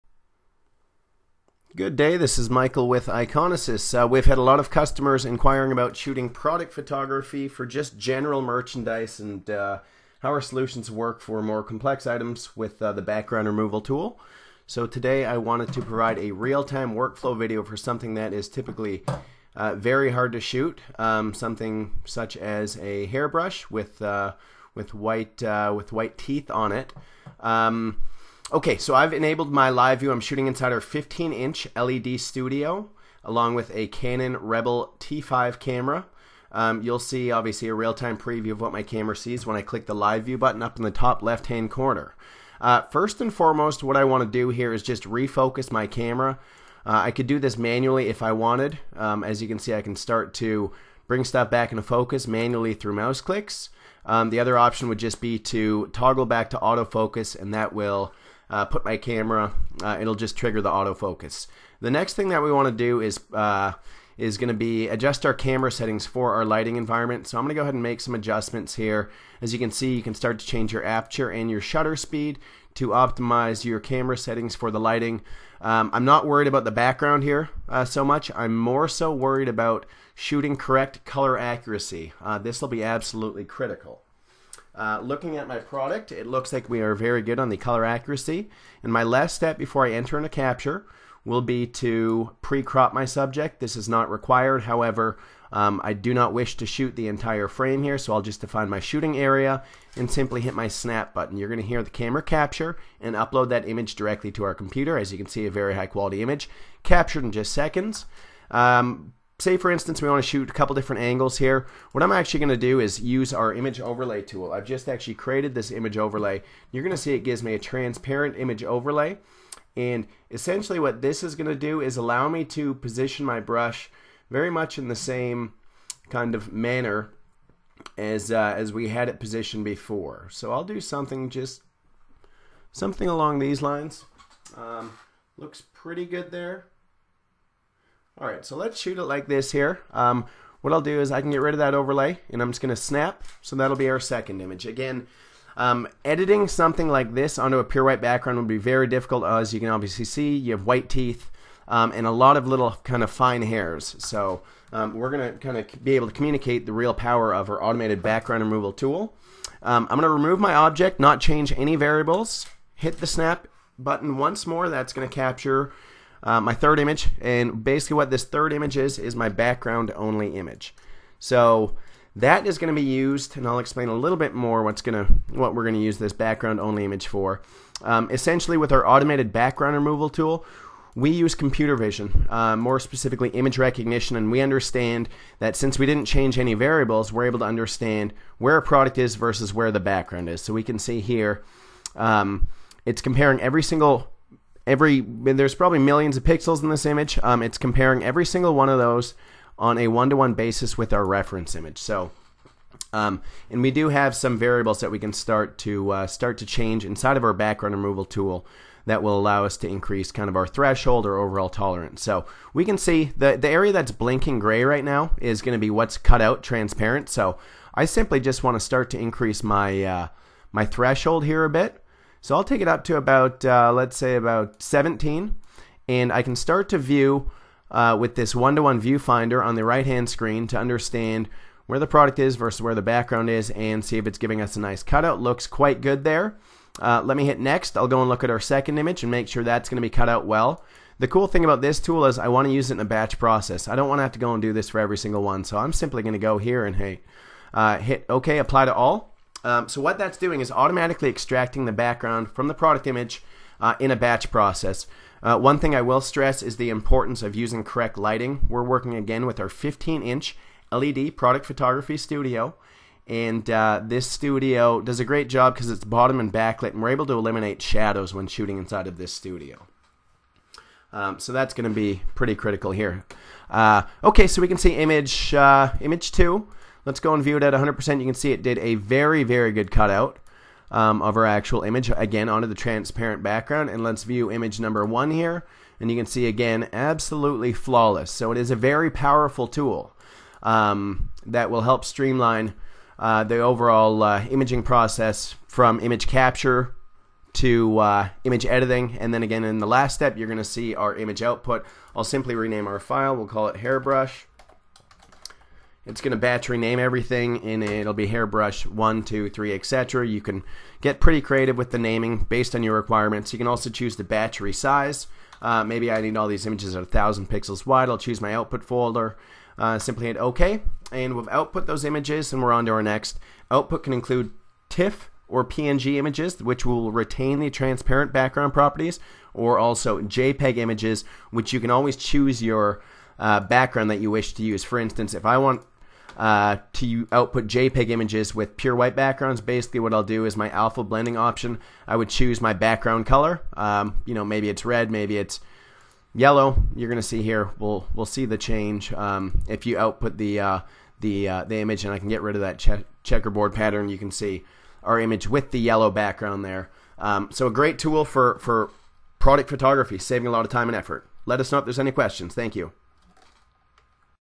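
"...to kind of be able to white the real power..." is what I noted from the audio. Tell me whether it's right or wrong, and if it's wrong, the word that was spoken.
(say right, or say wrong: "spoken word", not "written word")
wrong: "communicate", not "white".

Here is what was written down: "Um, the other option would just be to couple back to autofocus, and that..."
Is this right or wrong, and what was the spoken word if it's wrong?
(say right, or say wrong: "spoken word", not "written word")
wrong: "toggle", not "couple".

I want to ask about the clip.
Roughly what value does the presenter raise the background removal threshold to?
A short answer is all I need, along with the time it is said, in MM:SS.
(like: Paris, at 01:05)
17, at 03:44.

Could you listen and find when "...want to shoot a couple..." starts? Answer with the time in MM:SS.
01:50.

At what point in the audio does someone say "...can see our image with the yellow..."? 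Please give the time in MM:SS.
05:53.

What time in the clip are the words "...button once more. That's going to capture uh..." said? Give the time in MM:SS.
02:43.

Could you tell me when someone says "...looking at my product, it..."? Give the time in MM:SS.
01:25.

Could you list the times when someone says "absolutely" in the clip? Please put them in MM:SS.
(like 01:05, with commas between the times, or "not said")
01:22, 04:46.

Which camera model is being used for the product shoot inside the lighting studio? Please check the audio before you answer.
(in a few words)
Canon Rebel T5.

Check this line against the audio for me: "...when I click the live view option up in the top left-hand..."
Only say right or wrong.
wrong.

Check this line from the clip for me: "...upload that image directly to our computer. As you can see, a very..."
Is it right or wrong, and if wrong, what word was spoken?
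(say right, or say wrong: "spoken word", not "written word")
right.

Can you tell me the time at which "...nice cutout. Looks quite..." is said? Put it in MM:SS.
03:54.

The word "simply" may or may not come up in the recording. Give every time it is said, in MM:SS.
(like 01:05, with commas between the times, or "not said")
01:40, 03:37, 04:05, 05:02, 05:19.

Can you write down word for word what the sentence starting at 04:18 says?
We're working again with our 15 inch LED product photography studio.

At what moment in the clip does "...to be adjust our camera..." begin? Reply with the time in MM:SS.
01:04.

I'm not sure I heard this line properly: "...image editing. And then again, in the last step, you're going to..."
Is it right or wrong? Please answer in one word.
right.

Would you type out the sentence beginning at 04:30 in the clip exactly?
Um, so that's going to be pretty critical here.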